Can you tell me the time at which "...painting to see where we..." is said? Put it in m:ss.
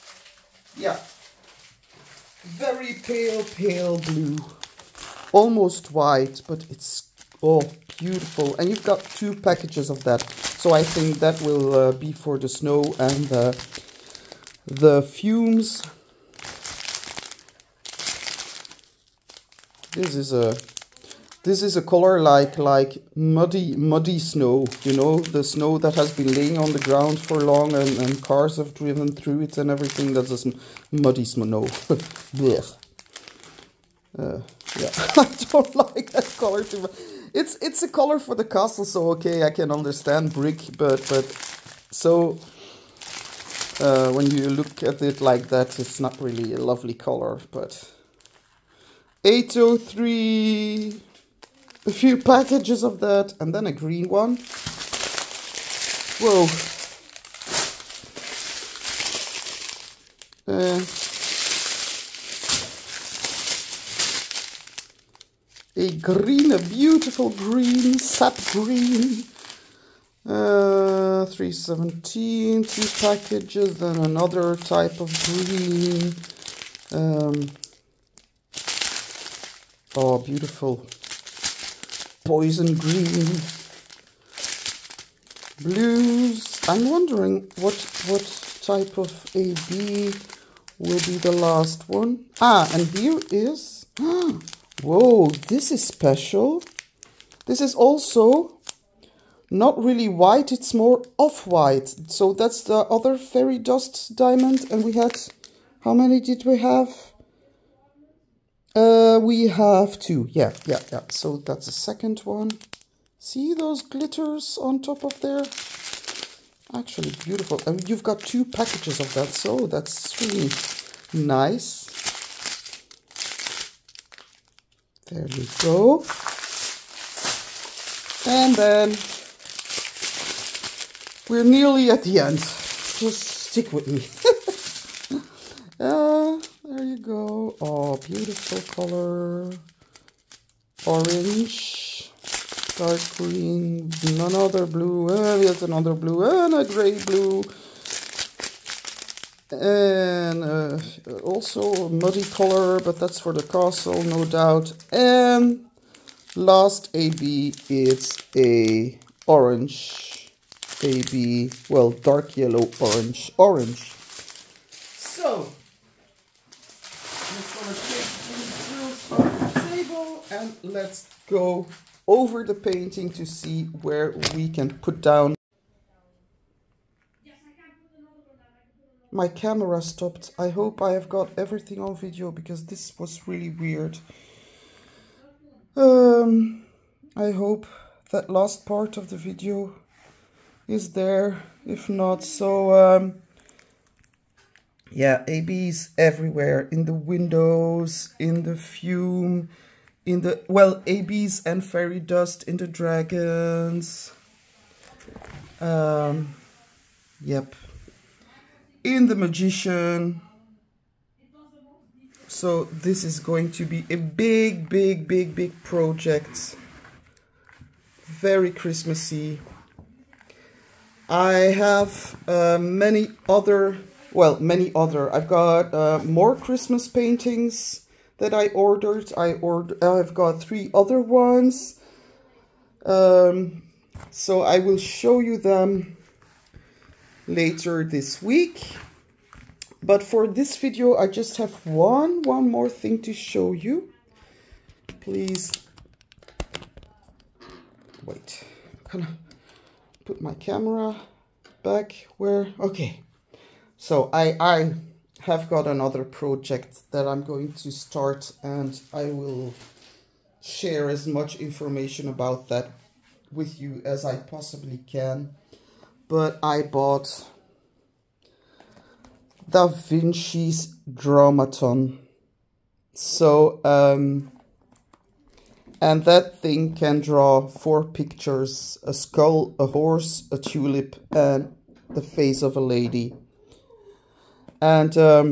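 2:52.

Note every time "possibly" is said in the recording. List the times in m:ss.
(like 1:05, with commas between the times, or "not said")
4:24.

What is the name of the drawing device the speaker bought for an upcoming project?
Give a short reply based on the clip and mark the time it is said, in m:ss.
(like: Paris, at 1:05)
Da Vinci's Drawmaton, at 4:29.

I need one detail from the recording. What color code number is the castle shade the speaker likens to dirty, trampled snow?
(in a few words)
803.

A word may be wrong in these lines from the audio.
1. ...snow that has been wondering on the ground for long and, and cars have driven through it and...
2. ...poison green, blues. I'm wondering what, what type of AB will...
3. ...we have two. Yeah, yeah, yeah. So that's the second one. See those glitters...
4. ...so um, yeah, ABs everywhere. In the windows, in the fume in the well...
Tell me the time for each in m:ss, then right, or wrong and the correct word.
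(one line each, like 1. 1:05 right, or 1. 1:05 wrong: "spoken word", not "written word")
1. 0:25 wrong: "laying", not "wondering"
2. 1:22 right
3. 1:49 right
4. 3:12 right.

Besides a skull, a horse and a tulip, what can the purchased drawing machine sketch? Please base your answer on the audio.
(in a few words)
the face of a lady.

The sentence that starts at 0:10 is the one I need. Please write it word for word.
So I think that will uh, be for the snow and the, the fumes.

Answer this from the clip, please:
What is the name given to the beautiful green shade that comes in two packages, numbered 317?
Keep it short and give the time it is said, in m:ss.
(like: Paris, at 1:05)
sap green, at 1:07.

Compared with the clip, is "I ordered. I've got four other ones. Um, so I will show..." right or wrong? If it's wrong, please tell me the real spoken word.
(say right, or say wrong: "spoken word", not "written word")
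wrong: "three", not "four".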